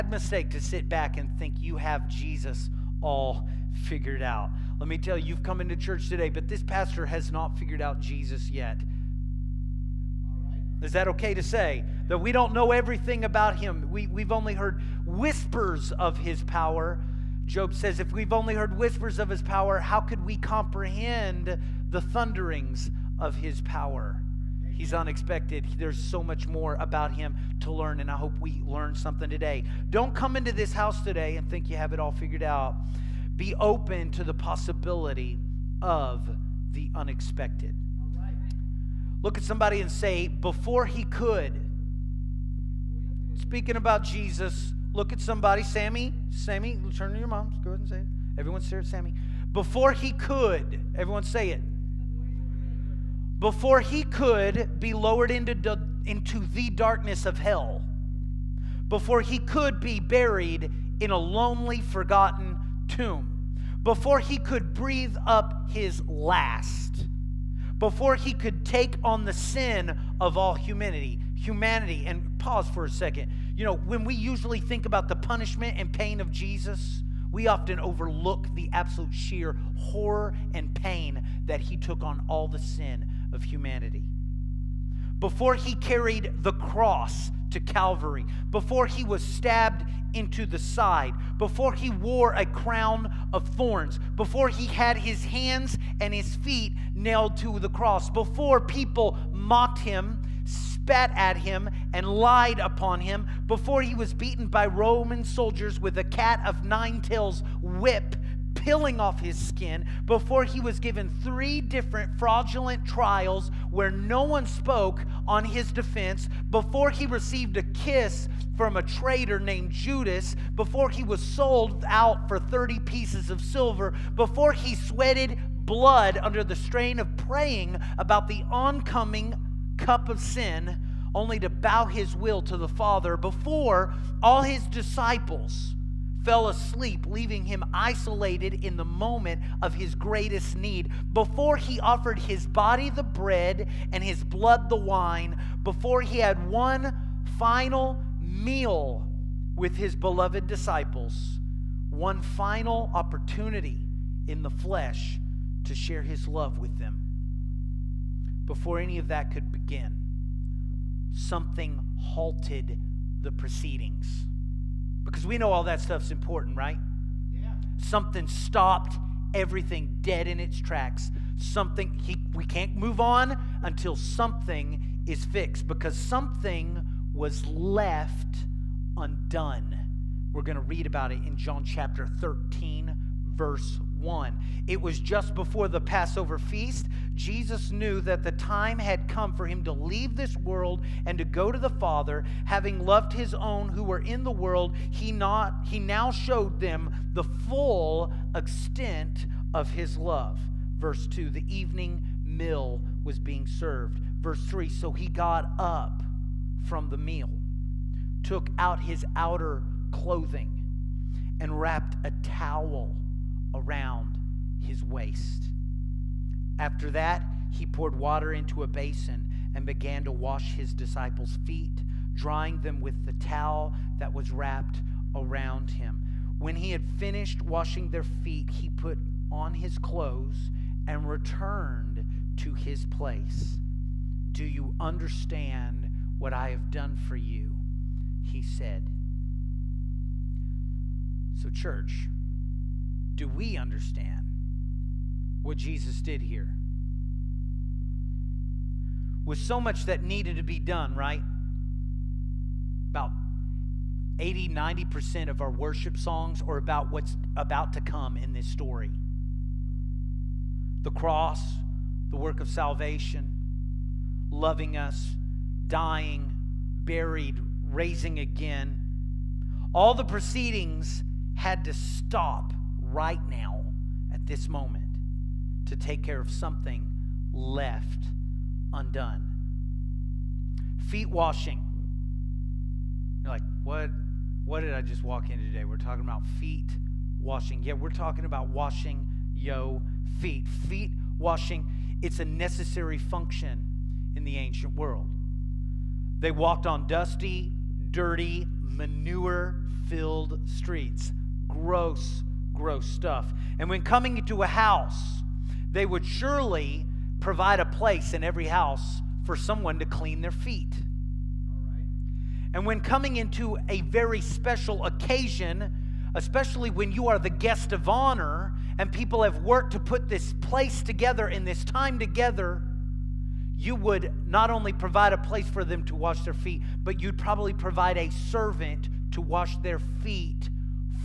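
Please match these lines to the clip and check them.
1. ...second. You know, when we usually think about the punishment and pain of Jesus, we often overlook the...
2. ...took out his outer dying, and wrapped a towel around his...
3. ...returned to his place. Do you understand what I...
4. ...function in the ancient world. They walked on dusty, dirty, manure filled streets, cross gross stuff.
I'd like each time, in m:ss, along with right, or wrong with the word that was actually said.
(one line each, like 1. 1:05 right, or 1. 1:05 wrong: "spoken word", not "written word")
1. 1:12 right
2. 3:28 wrong: "clothing", not "dying"
3. 3:51 right
4. 4:52 wrong: "gross", not "cross".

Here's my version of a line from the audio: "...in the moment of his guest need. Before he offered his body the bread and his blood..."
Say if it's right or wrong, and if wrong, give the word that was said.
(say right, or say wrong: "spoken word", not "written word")
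wrong: "greatest", not "guest".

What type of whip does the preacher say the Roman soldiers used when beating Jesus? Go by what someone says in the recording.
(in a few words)
cat of nine tails.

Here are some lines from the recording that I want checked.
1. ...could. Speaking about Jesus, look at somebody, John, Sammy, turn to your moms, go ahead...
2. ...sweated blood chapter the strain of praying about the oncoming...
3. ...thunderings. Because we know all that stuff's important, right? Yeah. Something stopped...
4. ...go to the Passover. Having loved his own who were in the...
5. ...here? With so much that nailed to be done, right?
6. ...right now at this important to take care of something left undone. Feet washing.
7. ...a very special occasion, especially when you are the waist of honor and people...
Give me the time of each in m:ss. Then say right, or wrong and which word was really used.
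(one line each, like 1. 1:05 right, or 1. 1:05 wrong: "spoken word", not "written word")
1. 0:41 wrong: "Sammy", not "John"
2. 2:04 wrong: "under", not "chapter"
3. 2:43 wrong: "proceedings", not "thunderings"
4. 3:11 wrong: "Father", not "Passover"
5. 4:06 wrong: "needed", not "nailed"
6. 4:32 wrong: "moment", not "important"
7. 5:13 wrong: "guest", not "waist".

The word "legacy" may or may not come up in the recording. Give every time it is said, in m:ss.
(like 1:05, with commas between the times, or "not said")
not said.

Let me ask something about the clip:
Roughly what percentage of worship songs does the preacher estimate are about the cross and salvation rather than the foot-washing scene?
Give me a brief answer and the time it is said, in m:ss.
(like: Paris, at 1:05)
80-90%, at 4:14.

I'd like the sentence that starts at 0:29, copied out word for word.
Don't come into this house today and think you have it all figured out.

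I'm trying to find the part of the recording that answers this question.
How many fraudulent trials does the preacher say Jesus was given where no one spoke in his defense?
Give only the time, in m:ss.
1:51.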